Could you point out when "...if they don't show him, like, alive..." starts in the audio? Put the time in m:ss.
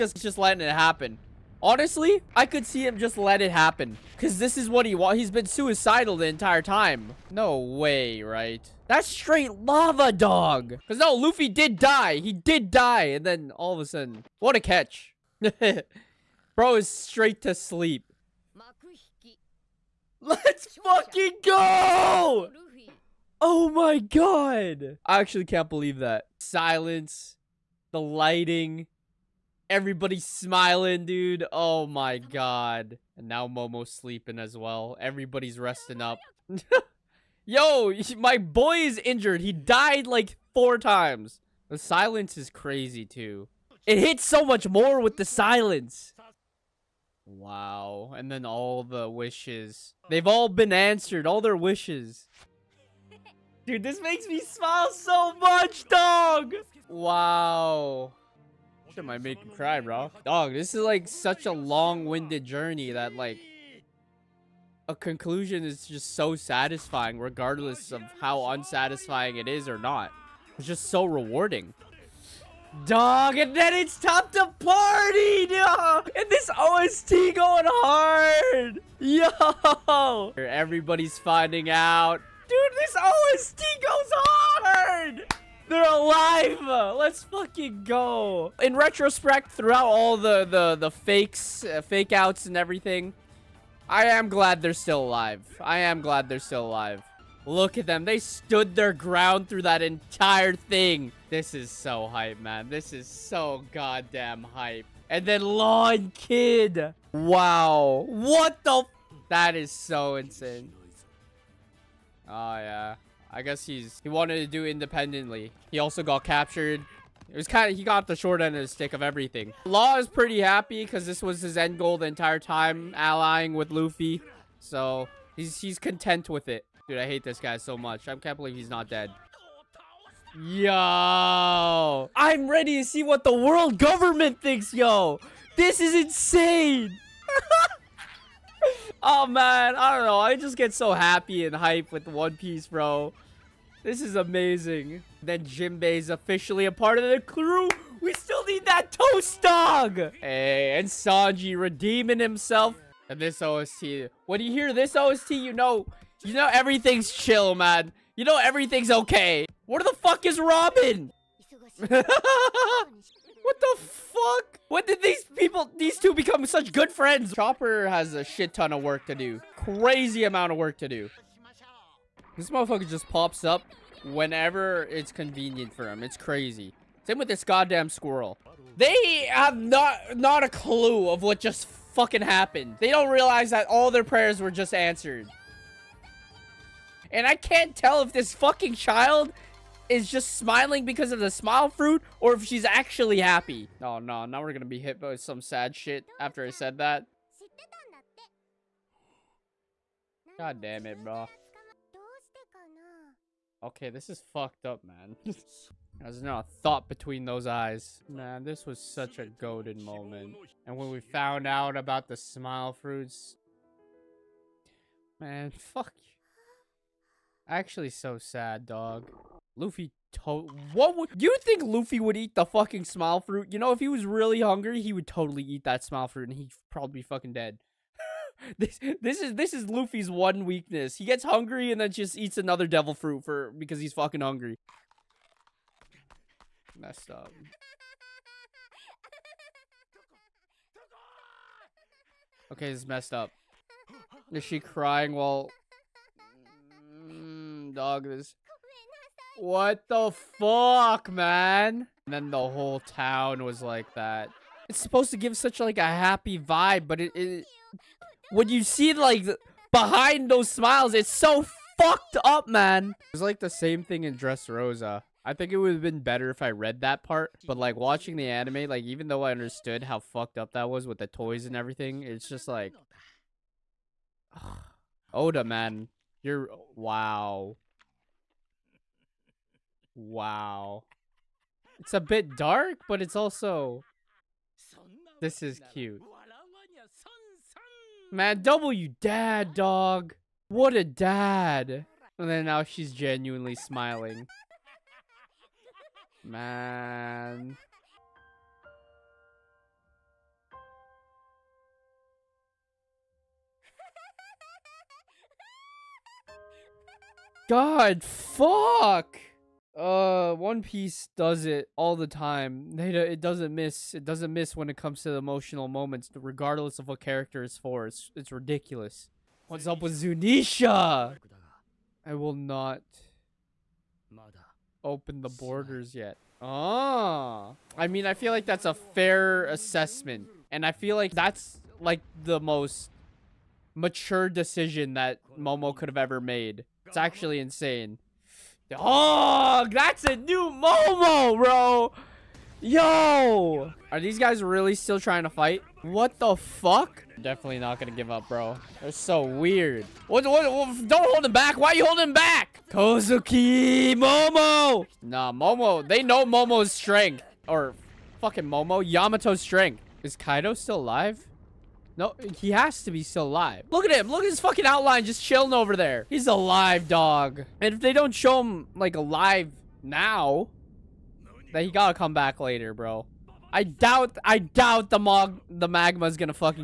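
6:07.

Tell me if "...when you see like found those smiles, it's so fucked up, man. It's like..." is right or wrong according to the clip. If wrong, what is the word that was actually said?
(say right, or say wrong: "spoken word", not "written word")
wrong: "behind", not "found".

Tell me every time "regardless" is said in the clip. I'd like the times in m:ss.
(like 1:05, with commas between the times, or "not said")
1:07, 5:16.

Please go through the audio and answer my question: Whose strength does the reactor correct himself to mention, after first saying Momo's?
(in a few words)
Yamato.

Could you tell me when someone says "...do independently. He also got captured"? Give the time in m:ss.
1:54.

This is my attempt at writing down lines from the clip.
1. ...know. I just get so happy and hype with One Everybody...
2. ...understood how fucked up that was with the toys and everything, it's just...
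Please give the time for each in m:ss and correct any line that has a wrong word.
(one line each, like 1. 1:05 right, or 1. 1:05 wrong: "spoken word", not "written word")
1. 2:20 wrong: "Piece", not "Everybody"
2. 4:29 right.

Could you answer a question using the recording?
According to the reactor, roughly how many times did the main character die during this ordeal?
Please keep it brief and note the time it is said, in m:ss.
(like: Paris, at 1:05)
4, at 0:40.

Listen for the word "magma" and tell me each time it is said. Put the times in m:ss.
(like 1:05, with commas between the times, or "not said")
6:15.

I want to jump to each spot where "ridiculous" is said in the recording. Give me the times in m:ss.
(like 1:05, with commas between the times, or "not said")
5:18.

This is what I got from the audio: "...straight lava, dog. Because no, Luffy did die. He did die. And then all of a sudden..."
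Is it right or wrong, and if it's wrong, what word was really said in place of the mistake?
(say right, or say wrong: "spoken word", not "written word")
right.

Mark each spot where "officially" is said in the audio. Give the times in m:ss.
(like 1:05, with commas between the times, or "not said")
2:26.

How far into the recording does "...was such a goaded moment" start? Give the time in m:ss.
3:28.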